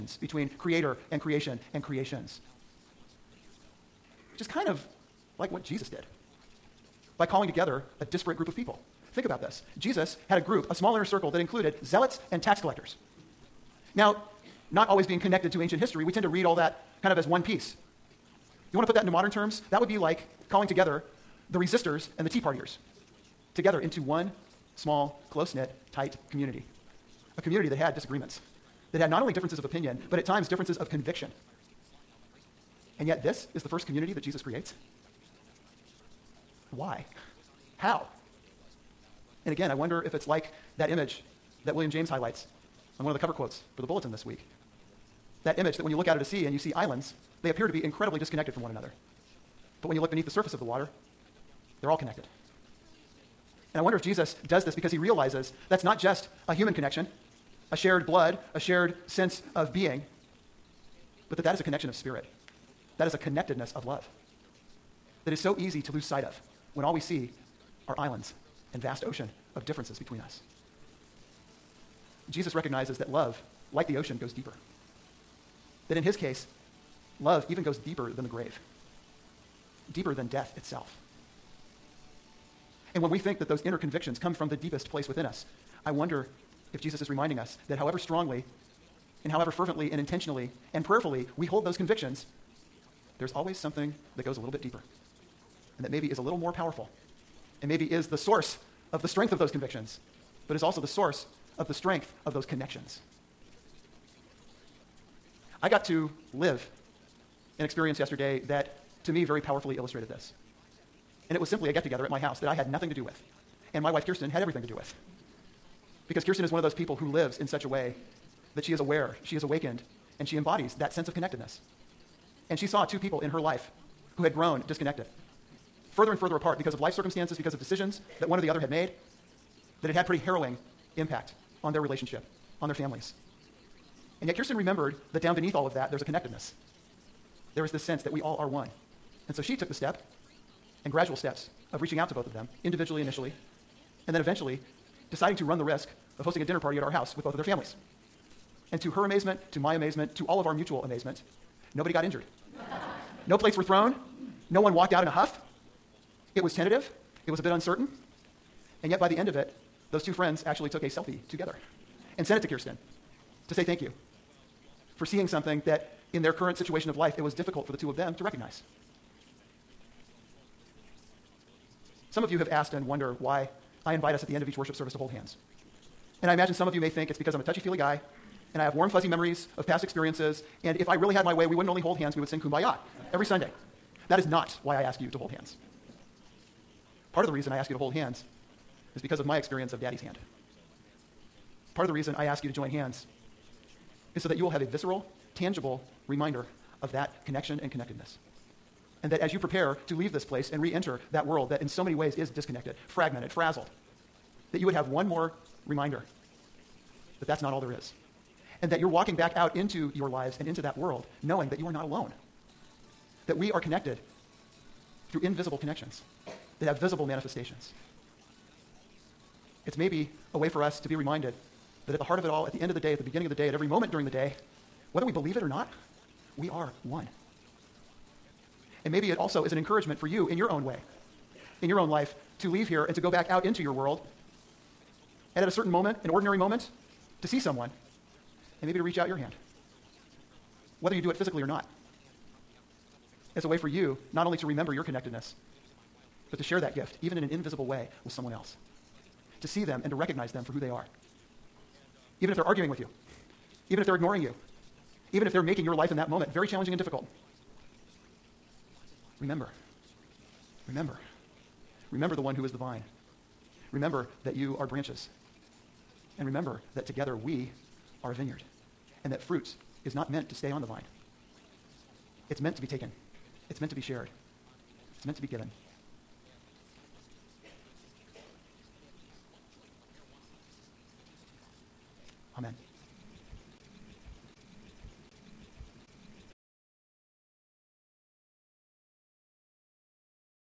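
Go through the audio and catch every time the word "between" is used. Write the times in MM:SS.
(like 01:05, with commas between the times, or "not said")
00:00, 01:09.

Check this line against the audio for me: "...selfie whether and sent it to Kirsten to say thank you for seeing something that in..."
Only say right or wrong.
wrong.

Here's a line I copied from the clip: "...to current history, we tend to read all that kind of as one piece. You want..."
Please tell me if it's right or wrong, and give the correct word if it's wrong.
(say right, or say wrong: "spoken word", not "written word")
wrong: "ancient", not "current".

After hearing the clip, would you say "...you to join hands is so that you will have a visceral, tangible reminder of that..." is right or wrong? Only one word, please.
right.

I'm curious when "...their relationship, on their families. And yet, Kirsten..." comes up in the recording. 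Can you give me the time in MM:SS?
02:11.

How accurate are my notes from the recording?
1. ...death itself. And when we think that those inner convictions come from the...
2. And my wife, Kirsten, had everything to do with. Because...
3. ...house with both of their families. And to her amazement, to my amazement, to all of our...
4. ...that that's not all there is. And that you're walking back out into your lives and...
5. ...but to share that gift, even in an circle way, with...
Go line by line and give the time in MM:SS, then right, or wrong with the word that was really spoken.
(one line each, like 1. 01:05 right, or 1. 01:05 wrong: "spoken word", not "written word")
1. 01:20 right
2. 01:53 right
3. 02:26 right
4. 03:27 right
5. 04:06 wrong: "invisible", not "circle".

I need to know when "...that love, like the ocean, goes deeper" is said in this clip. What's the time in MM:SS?
01:12.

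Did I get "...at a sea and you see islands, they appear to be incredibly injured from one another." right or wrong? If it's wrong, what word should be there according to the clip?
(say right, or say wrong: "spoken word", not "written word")
wrong: "disconnected", not "injured".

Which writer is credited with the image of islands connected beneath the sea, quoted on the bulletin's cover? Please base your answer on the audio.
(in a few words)
William James.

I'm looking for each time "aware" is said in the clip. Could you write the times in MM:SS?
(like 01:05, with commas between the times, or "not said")
01:58.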